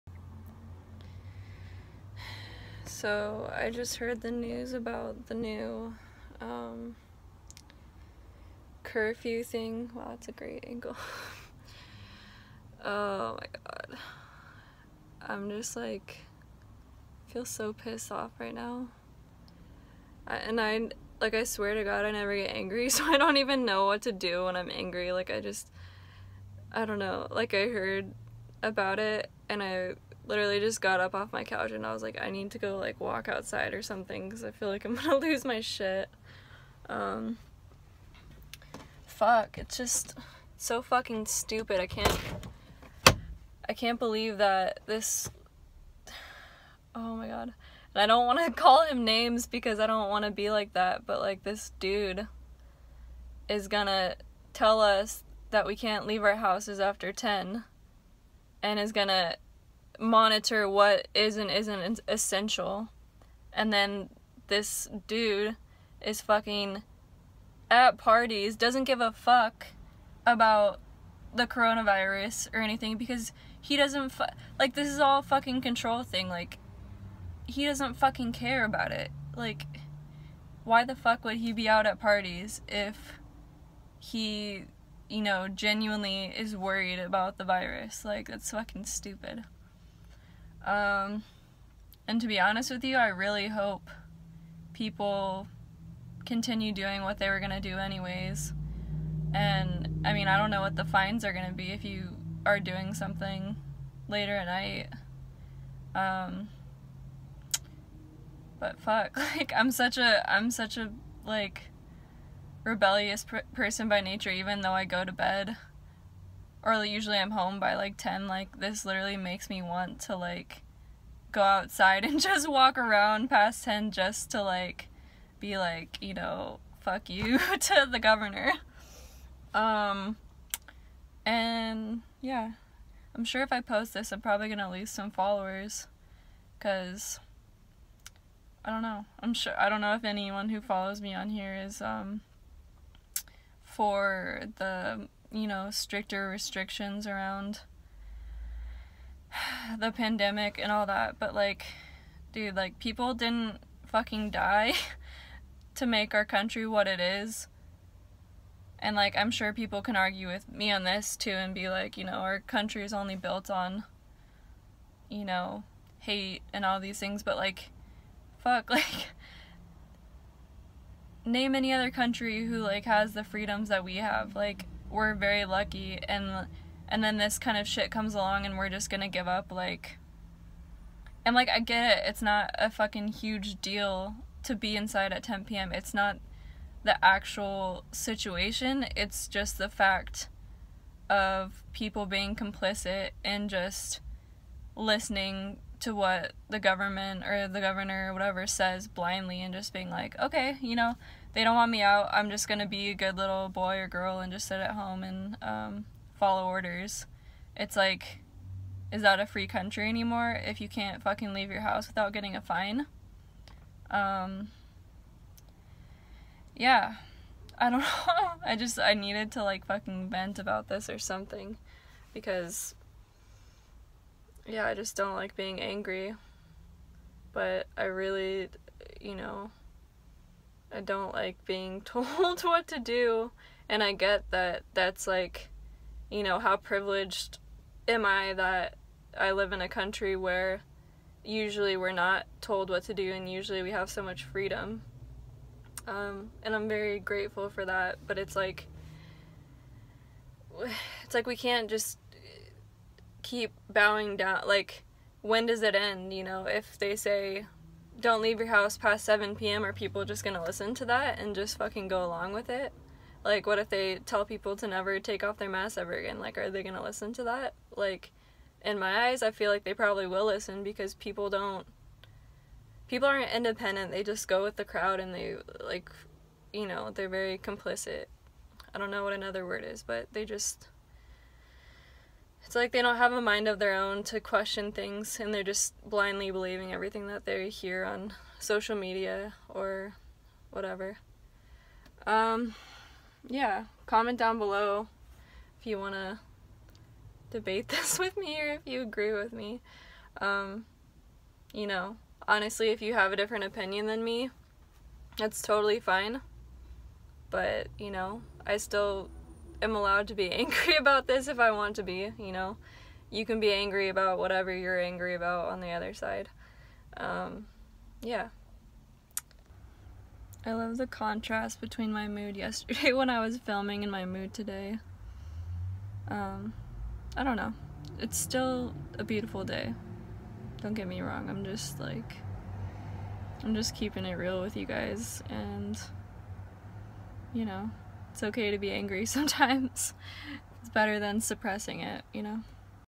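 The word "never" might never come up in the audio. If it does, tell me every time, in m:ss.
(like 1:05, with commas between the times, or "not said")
0:22, 4:24.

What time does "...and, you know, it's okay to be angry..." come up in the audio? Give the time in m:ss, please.
5:35.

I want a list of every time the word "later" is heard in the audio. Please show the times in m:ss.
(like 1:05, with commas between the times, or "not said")
1:44.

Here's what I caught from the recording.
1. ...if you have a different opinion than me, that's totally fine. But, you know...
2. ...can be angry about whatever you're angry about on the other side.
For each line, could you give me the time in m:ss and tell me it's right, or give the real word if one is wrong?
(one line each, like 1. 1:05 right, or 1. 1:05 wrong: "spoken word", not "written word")
1. 5:02 right
2. 5:13 right.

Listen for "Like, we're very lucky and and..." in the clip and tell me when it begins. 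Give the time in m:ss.
2:54.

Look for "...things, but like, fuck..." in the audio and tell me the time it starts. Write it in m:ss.
2:46.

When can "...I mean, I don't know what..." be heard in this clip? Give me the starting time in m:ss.
1:40.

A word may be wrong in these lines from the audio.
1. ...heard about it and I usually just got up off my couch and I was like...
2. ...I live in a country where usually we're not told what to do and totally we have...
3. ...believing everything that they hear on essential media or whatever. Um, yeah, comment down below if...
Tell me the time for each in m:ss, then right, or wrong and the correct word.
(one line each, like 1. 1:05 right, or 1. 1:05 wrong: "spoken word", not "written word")
1. 0:27 wrong: "literally", not "usually"
2. 3:59 wrong: "usually", not "totally"
3. 4:46 wrong: "social", not "essential".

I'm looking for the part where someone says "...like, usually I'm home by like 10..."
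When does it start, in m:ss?
1:56.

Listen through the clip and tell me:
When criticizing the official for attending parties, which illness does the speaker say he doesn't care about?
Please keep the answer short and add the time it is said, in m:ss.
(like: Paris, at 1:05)
coronavirus, at 1:11.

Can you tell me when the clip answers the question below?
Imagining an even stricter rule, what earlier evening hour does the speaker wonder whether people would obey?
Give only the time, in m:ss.
4:19.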